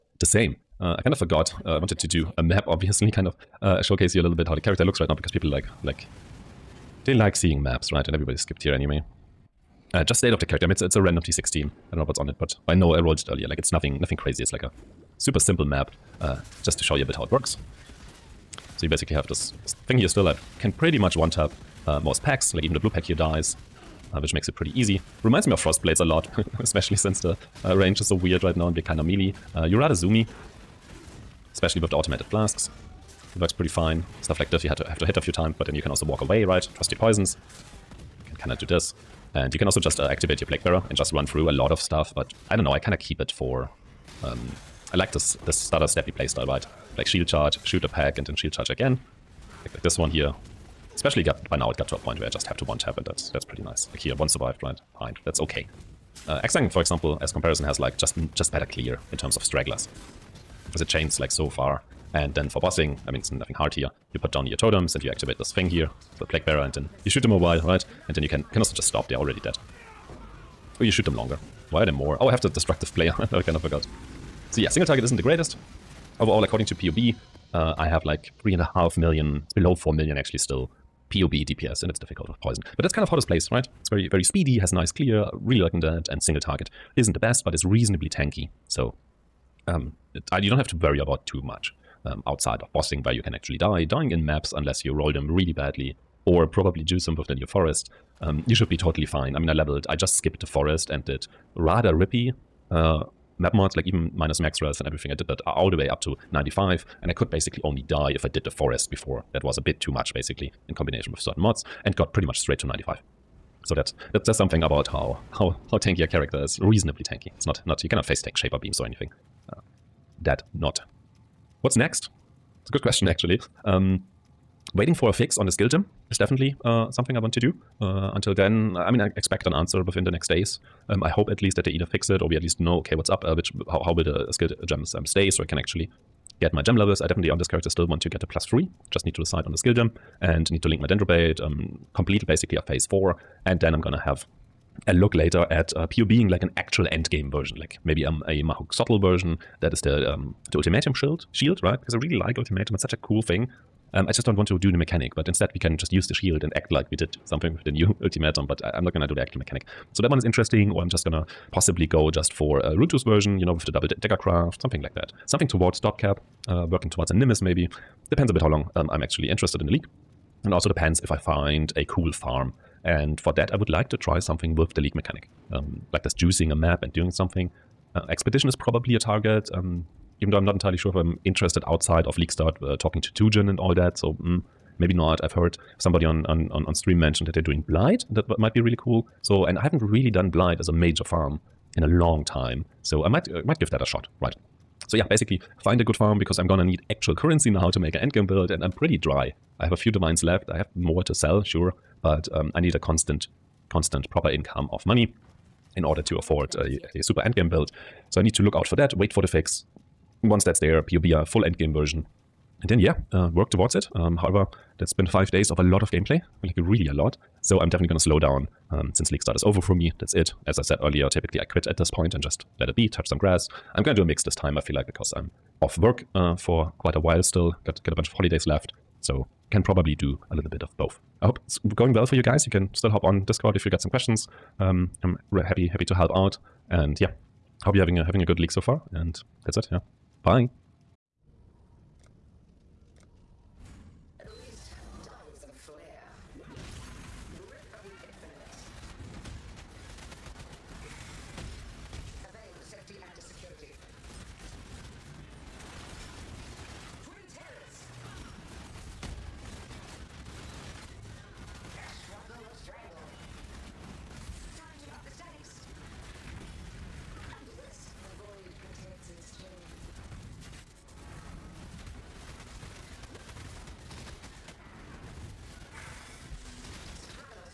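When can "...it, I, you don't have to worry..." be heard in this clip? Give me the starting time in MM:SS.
01:30.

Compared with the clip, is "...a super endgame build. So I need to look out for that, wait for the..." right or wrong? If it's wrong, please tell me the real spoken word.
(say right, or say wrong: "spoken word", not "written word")
right.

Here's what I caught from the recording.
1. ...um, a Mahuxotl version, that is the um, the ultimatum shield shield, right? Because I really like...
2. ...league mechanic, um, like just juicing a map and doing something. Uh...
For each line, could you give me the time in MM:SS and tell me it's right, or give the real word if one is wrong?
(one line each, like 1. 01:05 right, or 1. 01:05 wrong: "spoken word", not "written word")
1. 02:28 right
2. 02:54 right.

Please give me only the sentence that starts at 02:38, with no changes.
But I, am not gonna do the actual mechanic.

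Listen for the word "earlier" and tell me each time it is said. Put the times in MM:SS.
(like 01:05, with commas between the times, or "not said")
00:13, 03:40.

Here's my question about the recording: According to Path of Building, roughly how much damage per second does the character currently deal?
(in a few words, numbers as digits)
3.5 million.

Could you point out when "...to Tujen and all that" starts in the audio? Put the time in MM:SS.
03:03.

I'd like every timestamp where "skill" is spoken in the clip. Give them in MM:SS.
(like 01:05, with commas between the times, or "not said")
02:05, 02:14, 02:19.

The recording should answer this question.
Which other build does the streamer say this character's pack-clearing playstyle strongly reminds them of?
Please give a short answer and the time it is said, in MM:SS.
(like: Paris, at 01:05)
Frost Blades, at 00:25.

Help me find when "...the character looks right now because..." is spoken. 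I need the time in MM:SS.
00:04.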